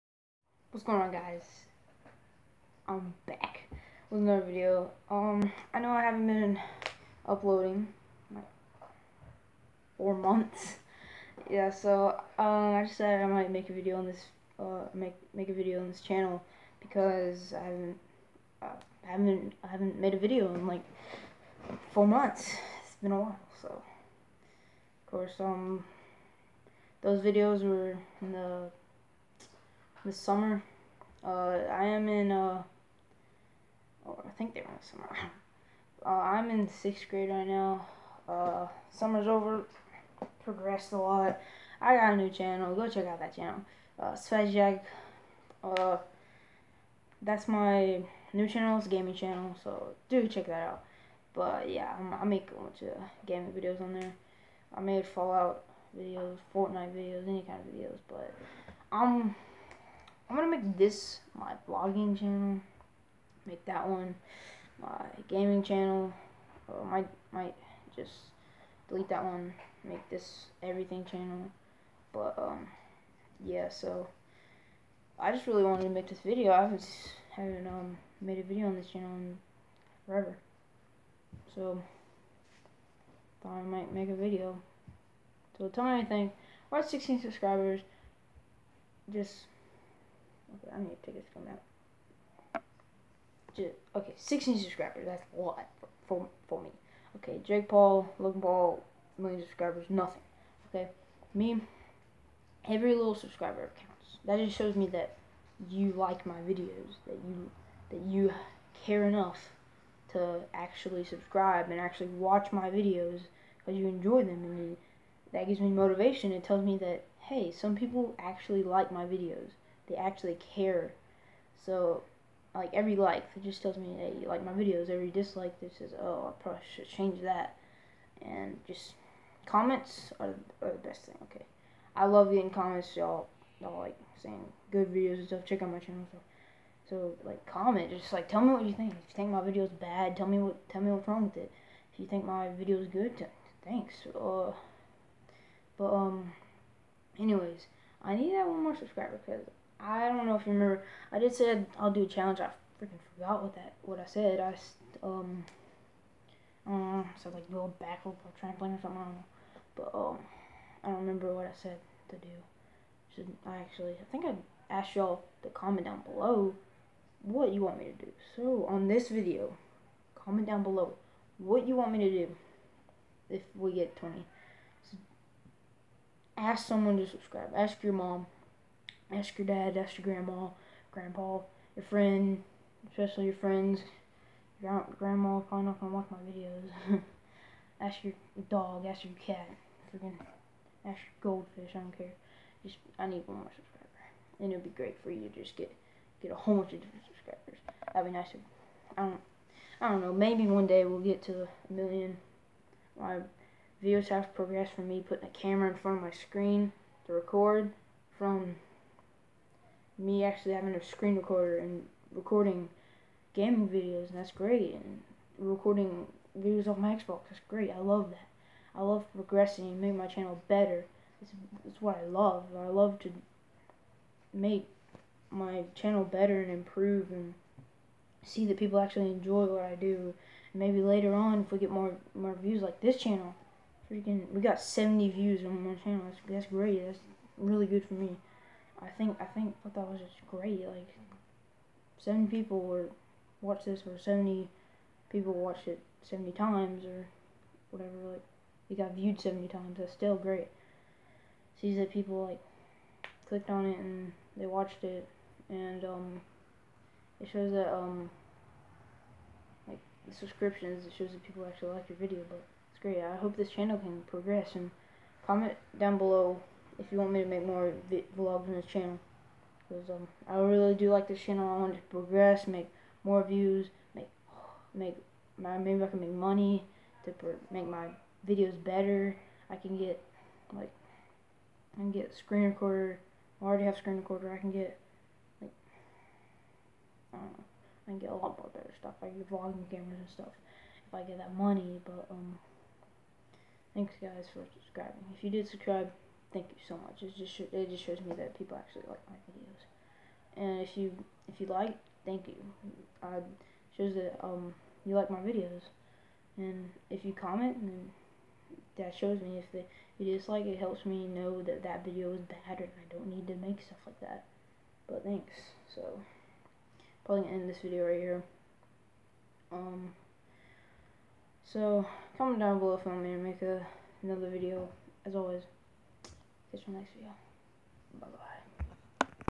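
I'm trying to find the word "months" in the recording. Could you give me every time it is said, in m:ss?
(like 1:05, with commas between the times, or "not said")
0:10, 0:22.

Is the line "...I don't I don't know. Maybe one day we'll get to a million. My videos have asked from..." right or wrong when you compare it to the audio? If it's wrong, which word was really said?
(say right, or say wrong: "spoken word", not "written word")
wrong: "progressed", not "asked".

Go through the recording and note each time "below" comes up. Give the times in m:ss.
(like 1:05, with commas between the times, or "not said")
2:46, 2:50, 4:25, 5:22.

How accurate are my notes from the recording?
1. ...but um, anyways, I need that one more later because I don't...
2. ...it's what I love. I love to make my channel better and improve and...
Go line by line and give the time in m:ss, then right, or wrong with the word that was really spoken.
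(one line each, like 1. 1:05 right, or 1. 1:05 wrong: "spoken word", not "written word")
1. 2:25 wrong: "subscriber", not "later"
2. 3:41 right.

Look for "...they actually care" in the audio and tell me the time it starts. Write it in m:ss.
1:59.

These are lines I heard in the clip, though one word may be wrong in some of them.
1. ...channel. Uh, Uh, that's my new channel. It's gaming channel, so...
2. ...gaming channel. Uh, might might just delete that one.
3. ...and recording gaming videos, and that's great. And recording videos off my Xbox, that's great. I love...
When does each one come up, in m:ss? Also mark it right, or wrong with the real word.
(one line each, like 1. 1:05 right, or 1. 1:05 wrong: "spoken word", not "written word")
1. 0:43 right
2. 1:05 right
3. 3:31 right.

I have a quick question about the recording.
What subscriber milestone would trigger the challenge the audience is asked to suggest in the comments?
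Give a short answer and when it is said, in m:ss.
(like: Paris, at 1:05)
20, at 2:53.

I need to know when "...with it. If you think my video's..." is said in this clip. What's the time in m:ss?
2:21.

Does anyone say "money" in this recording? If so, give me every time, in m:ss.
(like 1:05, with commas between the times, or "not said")
4:36, 4:51.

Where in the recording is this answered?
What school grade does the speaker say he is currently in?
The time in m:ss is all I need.
0:36.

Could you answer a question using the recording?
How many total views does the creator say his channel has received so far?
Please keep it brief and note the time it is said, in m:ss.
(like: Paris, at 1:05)
70, at 3:54.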